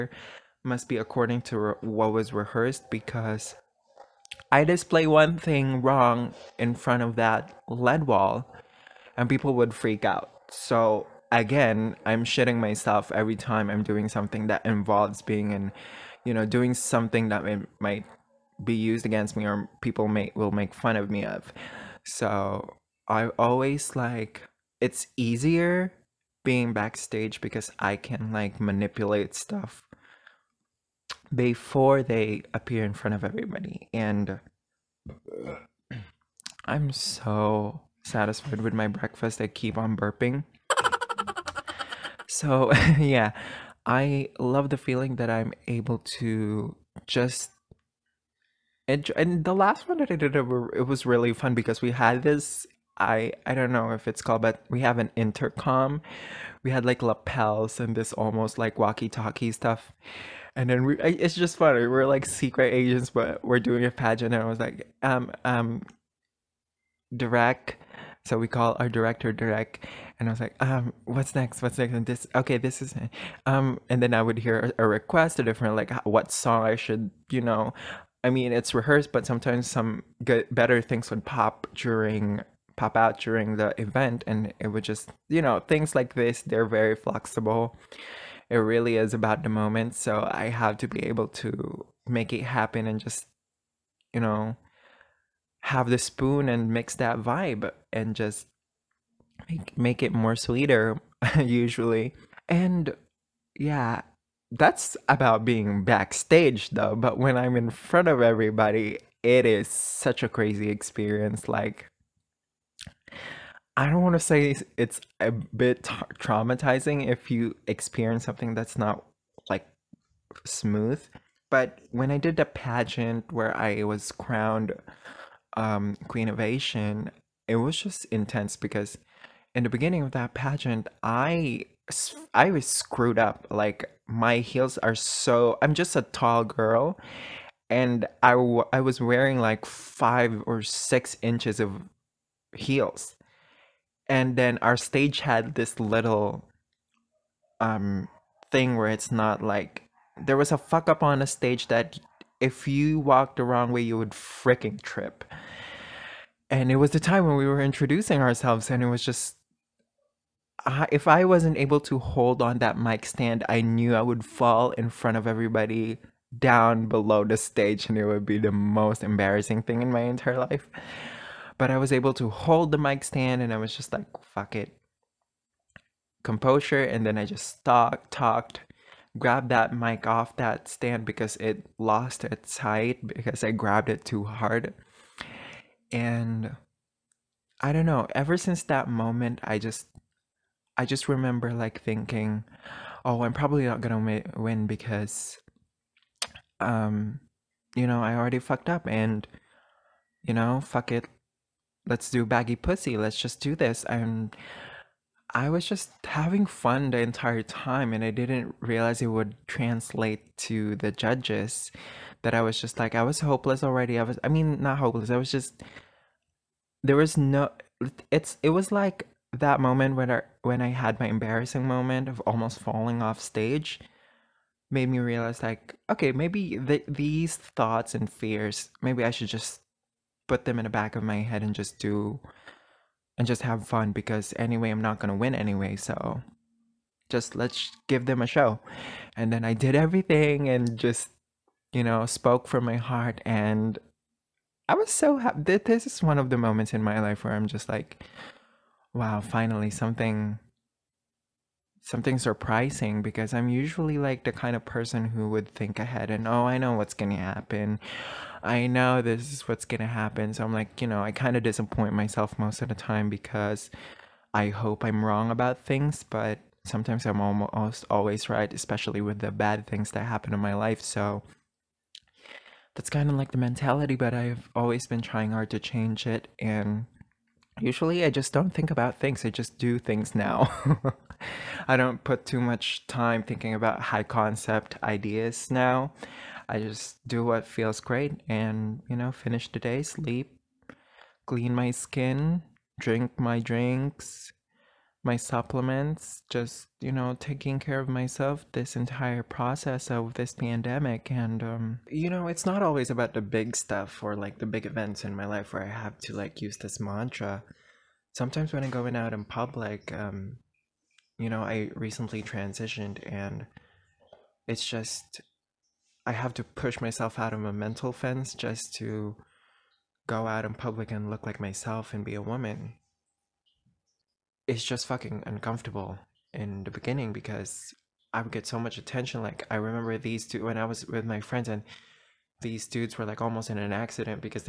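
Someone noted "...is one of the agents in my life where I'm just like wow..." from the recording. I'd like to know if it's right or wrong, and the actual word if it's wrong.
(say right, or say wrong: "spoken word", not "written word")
wrong: "moments", not "agents".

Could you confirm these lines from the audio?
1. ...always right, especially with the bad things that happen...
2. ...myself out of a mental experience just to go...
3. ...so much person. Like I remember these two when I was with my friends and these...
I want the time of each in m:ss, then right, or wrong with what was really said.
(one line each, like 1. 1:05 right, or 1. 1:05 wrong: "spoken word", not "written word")
1. 4:27 right
2. 5:16 wrong: "fence", not "experience"
3. 5:28 wrong: "attention", not "person".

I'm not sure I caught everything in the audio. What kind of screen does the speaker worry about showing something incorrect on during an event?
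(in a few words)
LED wall.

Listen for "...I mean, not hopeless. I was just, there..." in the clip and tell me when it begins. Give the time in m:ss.
3:34.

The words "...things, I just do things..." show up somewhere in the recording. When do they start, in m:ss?
4:38.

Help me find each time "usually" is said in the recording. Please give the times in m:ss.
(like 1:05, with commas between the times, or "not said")
1:41, 4:13, 4:37.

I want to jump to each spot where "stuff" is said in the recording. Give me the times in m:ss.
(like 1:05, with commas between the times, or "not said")
0:29, 0:59, 5:03.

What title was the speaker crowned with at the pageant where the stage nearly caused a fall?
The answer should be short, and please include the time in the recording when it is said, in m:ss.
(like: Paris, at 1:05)
Queen of Asian, at 2:06.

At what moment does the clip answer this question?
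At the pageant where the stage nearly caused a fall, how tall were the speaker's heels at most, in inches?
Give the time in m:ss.
2:20.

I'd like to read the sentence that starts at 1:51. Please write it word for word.
Like, I don't want to say it's, a bit traumatizing if you experience something that's not like smooth.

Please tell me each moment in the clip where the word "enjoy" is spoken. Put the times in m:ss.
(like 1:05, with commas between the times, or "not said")
0:48.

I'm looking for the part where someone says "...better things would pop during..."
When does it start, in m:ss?
1:20.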